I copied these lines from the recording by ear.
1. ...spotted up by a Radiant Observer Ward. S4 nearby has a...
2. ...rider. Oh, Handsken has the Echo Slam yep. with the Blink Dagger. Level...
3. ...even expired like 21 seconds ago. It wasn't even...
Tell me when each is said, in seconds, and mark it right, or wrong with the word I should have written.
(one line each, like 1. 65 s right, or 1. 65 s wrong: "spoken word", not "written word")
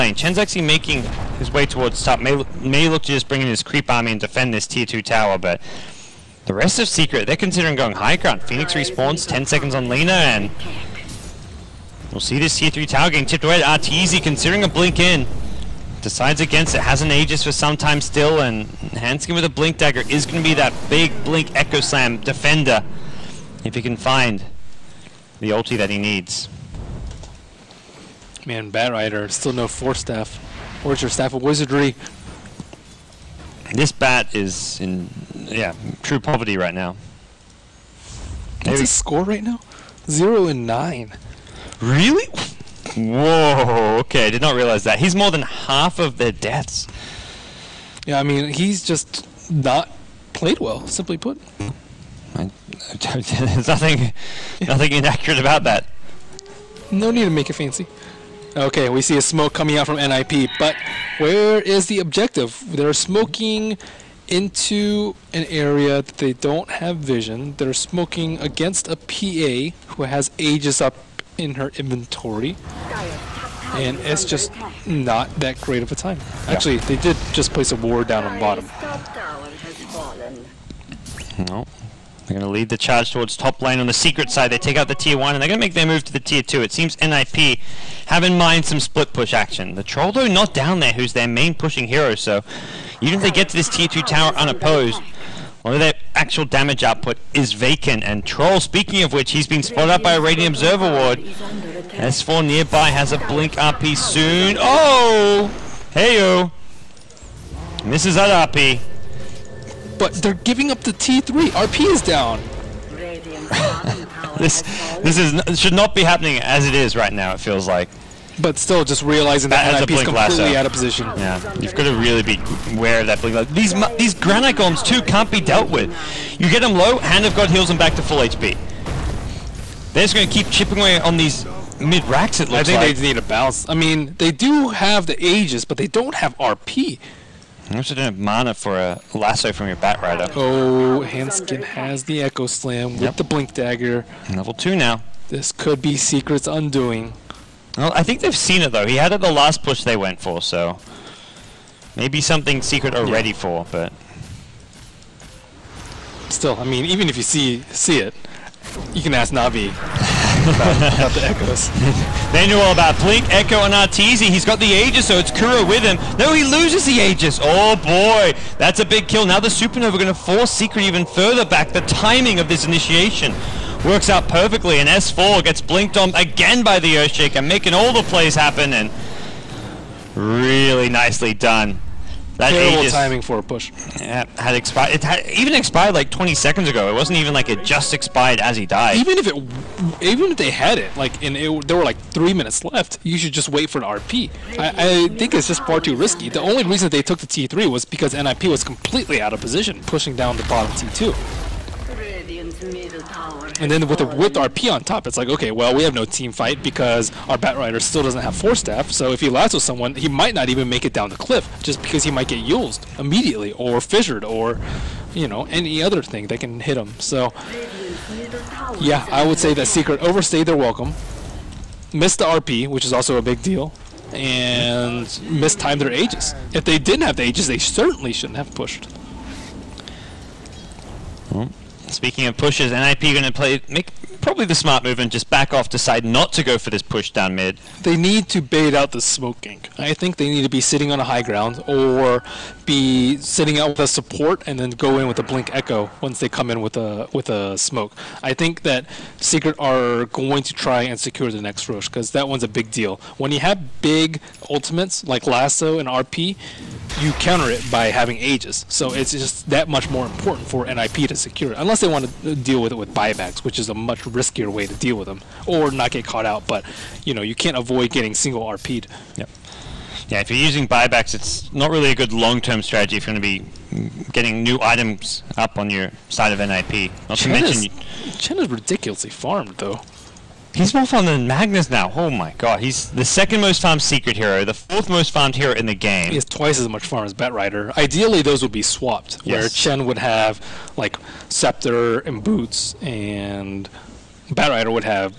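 1. 99 s right
2. 140 s right
3. 185 s wrong: "20", not "21".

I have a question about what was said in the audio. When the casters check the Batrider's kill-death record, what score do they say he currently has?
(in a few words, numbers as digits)
0 and 9.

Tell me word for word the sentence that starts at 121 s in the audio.
Yeah, you've got to really be aware of that blink These these granite golems too can't be dealt with.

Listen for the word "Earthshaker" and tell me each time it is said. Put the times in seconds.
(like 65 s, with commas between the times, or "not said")
176 s.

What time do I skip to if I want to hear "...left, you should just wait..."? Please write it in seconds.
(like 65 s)
192 s.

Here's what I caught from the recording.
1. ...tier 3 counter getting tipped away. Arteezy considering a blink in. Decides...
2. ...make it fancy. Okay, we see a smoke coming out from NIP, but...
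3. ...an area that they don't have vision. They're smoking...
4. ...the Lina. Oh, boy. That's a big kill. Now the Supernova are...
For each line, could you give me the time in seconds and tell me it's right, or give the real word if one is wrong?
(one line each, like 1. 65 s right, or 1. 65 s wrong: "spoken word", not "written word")
1. 12 s wrong: "tower", not "counter"
2. 57 s right
3. 65 s right
4. 166 s wrong: "Aegis", not "Lina".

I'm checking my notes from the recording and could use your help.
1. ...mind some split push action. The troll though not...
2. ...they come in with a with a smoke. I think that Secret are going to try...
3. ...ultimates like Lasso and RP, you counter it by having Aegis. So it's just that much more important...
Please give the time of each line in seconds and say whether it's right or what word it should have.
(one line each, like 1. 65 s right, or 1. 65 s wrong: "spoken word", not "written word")
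1. 88 s right
2. 246 s right
3. 254 s right.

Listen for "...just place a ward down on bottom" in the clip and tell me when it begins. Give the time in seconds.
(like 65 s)
77 s.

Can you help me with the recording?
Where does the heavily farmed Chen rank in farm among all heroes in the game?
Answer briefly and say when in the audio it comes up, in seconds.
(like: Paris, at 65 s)
Fourth, at 284 s.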